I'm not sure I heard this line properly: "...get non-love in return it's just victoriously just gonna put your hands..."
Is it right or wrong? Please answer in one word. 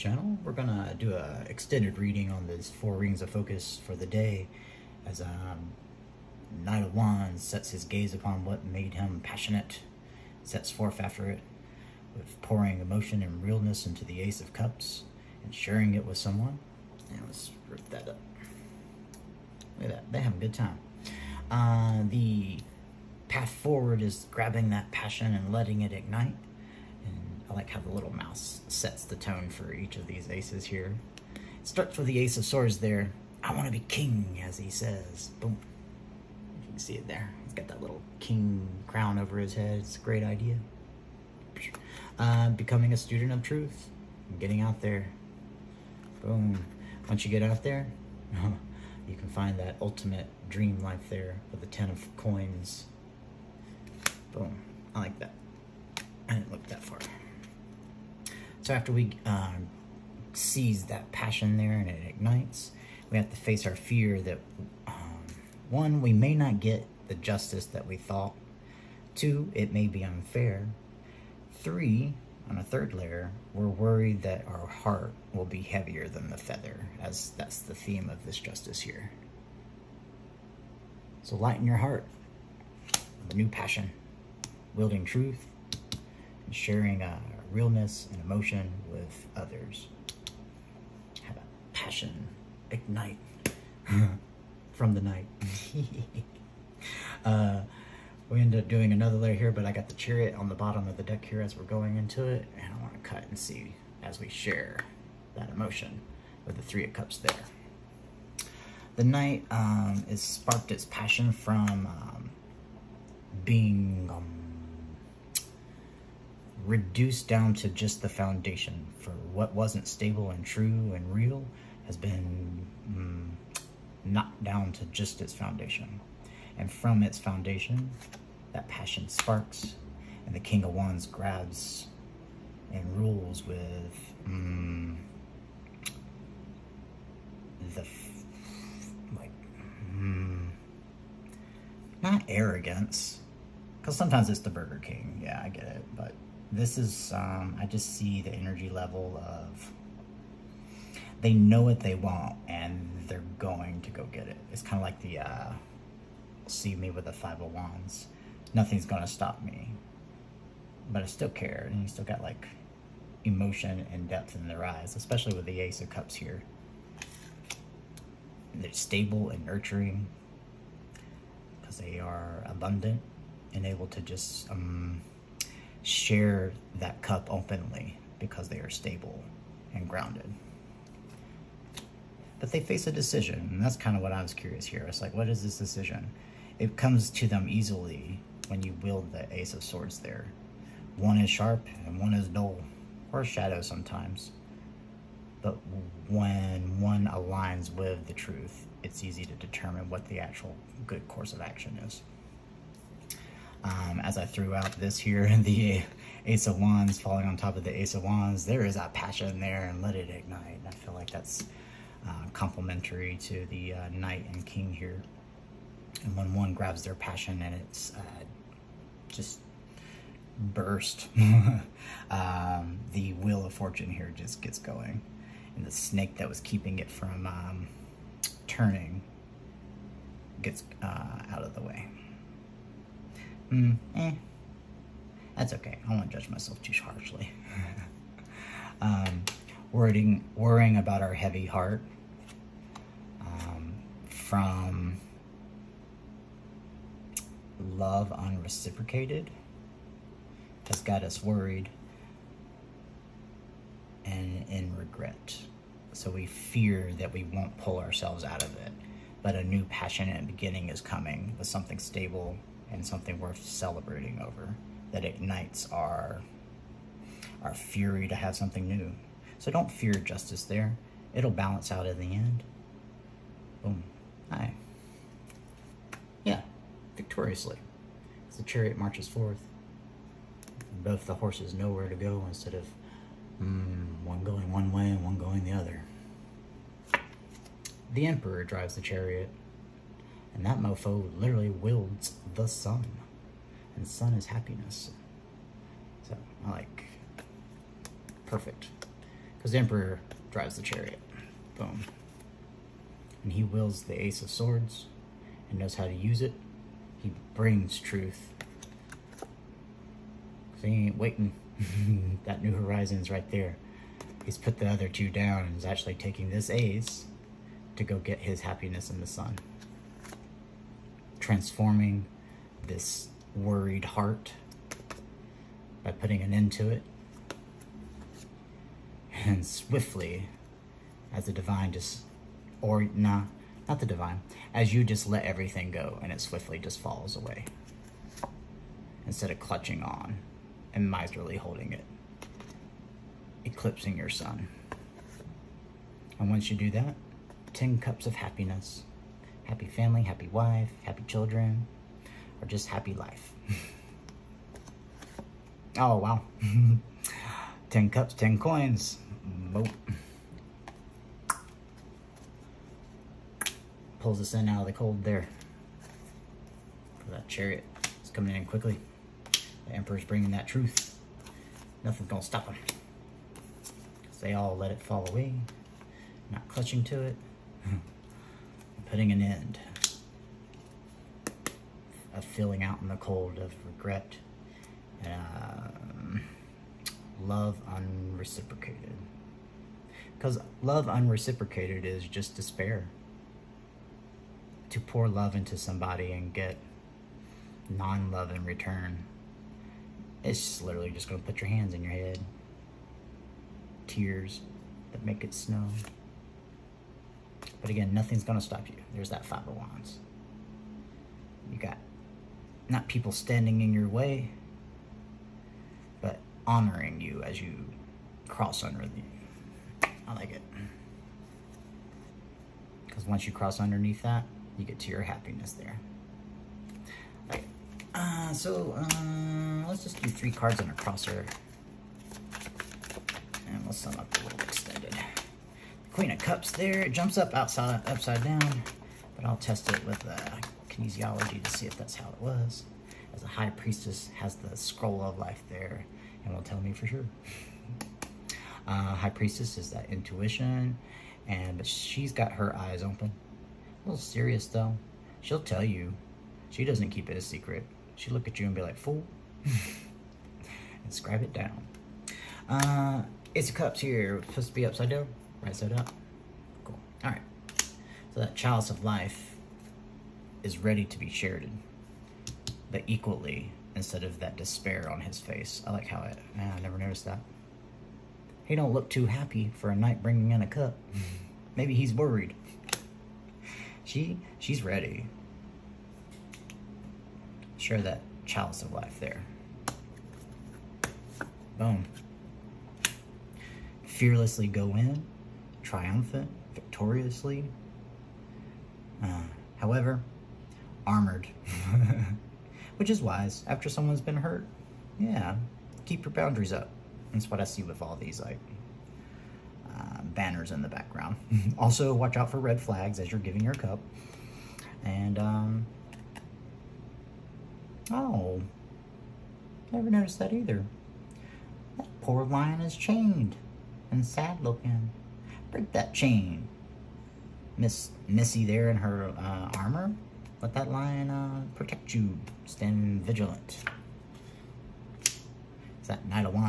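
wrong.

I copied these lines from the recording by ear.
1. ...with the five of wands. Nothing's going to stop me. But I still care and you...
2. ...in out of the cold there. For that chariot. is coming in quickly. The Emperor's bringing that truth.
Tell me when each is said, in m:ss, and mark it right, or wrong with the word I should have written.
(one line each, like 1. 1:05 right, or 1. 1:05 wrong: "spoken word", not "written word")
1. 2:36 right
2. 6:04 right.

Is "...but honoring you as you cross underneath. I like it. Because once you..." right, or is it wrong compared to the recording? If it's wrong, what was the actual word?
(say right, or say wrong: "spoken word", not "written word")
right.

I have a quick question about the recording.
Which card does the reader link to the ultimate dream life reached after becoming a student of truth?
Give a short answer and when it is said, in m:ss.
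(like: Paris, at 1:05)
Ten of Coins, at 0:51.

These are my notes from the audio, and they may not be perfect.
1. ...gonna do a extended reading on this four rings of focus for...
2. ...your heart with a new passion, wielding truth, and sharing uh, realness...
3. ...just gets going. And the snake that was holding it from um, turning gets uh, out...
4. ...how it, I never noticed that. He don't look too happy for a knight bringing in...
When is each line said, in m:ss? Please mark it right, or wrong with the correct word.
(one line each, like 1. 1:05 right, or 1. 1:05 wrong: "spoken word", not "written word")
1. 0:00 right
2. 1:21 right
3. 3:44 wrong: "keeping", not "holding"
4. 7:55 right.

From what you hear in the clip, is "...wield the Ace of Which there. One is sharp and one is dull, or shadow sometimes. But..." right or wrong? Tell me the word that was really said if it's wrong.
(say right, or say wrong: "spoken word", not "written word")
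wrong: "Swords", not "Which".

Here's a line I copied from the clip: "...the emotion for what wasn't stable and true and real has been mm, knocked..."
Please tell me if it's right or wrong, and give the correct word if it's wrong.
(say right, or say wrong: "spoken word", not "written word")
wrong: "foundation", not "emotion".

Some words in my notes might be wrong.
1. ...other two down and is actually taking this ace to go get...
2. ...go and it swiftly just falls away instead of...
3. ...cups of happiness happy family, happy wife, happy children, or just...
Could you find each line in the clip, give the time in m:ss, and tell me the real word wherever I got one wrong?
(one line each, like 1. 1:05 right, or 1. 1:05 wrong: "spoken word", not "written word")
1. 5:14 right
2. 5:35 right
3. 5:47 right.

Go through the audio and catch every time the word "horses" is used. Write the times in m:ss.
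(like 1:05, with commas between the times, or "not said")
4:41.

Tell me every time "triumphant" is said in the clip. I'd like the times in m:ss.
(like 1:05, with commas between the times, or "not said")
8:15.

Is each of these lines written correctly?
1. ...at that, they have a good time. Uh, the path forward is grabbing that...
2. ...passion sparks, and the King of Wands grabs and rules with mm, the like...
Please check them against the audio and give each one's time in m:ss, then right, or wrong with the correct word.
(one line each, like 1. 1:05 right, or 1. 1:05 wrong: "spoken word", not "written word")
1. 0:19 right
2. 2:08 right.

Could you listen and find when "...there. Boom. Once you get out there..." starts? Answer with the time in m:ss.
0:44.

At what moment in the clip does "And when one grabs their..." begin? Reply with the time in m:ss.
3:36.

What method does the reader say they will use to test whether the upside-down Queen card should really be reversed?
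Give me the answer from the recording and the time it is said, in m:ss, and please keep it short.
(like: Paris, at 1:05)
Kinesiology, at 7:20.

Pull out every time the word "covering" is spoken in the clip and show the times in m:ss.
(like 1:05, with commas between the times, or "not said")
not said.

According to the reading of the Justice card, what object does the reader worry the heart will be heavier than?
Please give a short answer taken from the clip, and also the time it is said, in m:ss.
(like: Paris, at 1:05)
The feather, at 1:16.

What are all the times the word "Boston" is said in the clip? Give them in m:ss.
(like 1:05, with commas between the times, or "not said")
not said.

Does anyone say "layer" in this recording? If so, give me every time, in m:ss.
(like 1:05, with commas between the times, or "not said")
1:12, 1:39.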